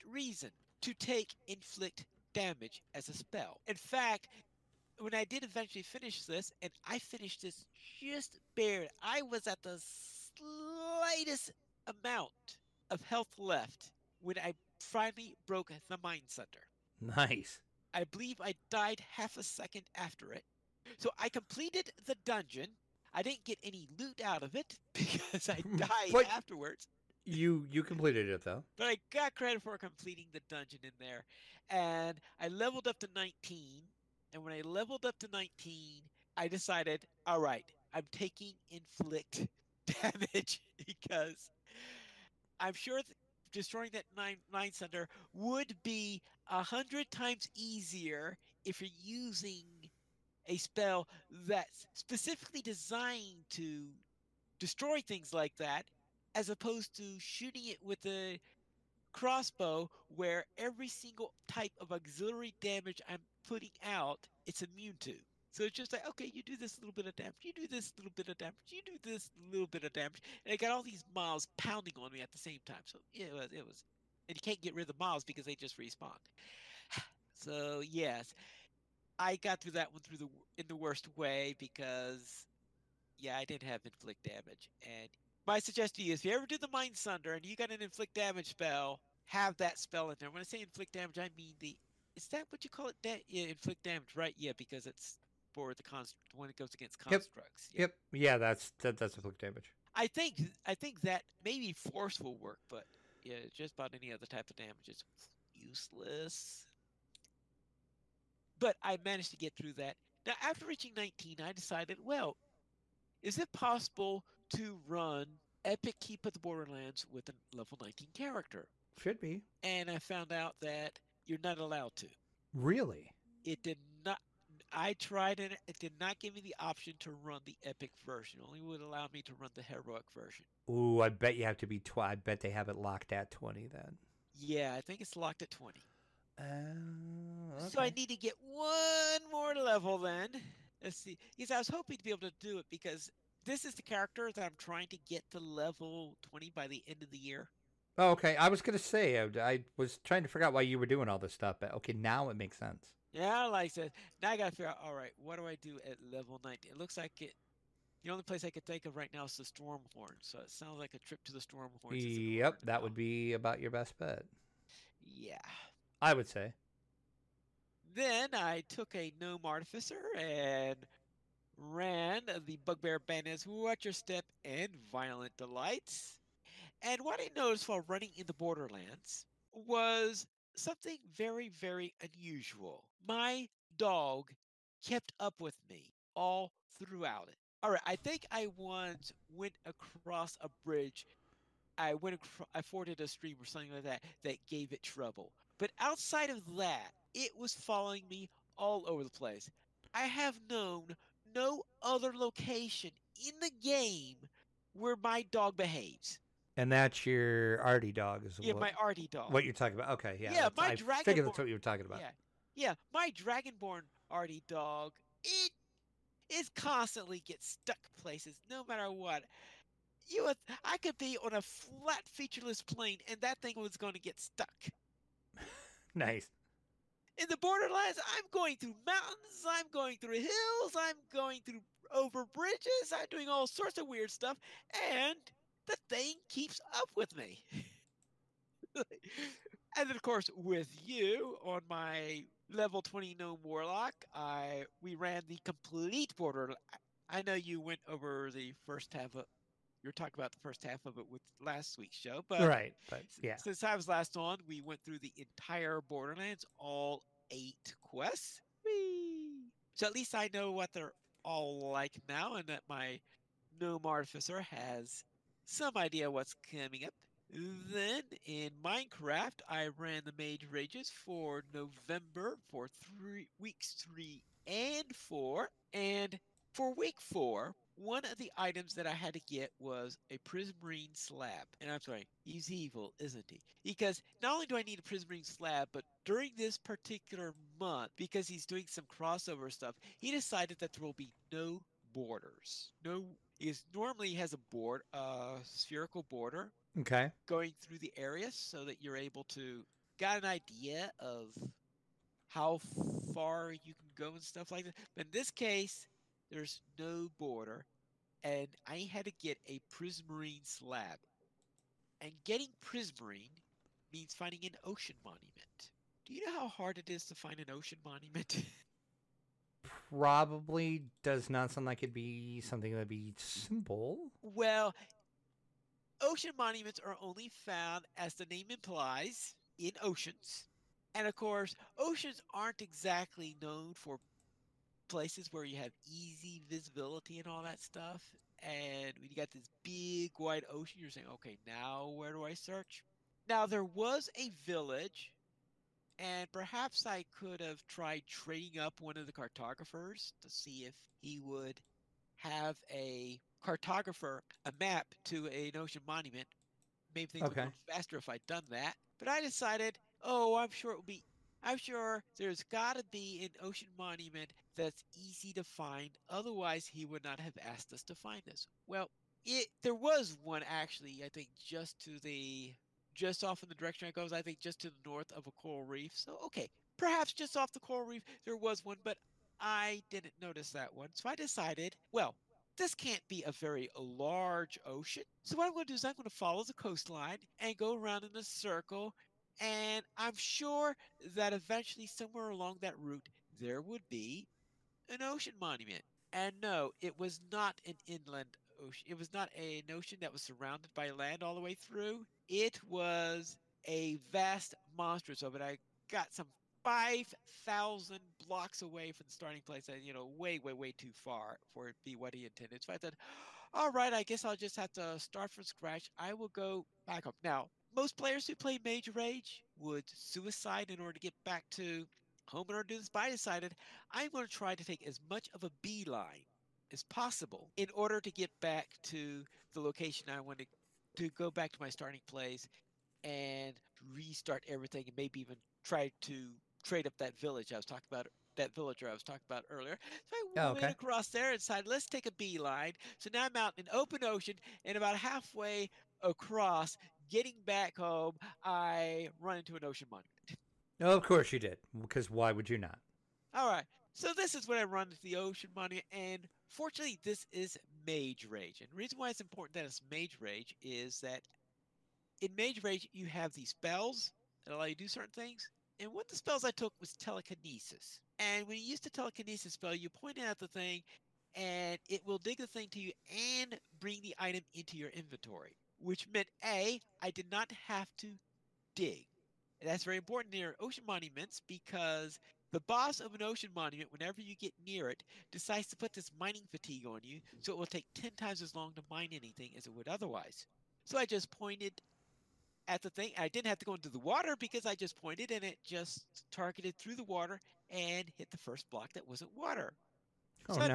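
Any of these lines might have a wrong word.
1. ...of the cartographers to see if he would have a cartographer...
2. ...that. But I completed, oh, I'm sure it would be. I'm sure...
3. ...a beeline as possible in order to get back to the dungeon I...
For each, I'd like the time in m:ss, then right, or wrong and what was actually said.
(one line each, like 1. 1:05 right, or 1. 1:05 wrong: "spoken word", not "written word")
1. 5:48 right
2. 5:58 wrong: "decided", not "completed"
3. 7:05 wrong: "location", not "dungeon".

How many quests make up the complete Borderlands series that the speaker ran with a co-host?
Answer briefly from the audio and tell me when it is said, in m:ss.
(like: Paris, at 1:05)
8, at 4:16.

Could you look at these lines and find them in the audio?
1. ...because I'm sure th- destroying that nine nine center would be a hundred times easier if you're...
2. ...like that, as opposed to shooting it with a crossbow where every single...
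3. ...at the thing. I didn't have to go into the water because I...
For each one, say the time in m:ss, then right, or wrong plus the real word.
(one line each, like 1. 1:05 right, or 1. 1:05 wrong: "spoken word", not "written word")
1. 0:40 right
2. 0:55 right
3. 8:12 right.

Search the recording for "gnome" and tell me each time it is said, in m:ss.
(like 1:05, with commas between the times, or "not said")
2:49, 4:03, 4:23.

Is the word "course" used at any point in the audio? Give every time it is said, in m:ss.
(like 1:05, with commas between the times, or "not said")
4:00, 5:31, 7:31.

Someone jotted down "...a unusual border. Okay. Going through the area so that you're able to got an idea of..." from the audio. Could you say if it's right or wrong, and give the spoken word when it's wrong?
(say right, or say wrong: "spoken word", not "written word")
wrong: "spherical", not "unusual".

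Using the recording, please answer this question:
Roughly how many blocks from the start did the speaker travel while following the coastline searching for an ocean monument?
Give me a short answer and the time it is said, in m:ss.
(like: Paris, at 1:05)
5,000, at 6:46.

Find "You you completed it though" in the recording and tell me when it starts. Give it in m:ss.
0:27.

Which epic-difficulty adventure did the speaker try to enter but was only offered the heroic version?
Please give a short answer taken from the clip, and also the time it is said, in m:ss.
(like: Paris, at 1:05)
Keep of the Borderlands, at 1:55.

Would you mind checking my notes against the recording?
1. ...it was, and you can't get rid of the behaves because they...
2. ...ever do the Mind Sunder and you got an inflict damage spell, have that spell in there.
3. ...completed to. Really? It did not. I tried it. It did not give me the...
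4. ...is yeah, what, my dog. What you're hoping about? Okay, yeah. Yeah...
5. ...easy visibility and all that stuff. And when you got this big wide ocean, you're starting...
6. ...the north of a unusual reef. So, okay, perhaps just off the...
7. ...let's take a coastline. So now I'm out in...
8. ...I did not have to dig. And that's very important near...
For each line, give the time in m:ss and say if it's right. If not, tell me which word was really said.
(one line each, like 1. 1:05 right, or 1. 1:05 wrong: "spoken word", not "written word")
1. 1:13 wrong: "miles", not "behaves"
2. 1:26 right
3. 2:01 wrong: "allowed", not "completed"
4. 3:28 wrong: "talking", not "hoping"
5. 5:35 wrong: "saying", not "starting"
6. 6:14 wrong: "coral", not "unusual"
7. 7:21 wrong: "beeline", not "coastline"
8. 7:56 right.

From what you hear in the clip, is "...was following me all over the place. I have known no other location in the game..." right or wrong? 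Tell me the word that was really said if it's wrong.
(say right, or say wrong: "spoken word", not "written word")
right.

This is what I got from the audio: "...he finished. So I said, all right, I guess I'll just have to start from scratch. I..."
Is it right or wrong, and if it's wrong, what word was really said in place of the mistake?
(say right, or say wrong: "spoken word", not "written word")
wrong: "intended", not "finished".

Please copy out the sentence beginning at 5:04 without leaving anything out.
But in this case, there's no border, and I had to get a prismarine slab.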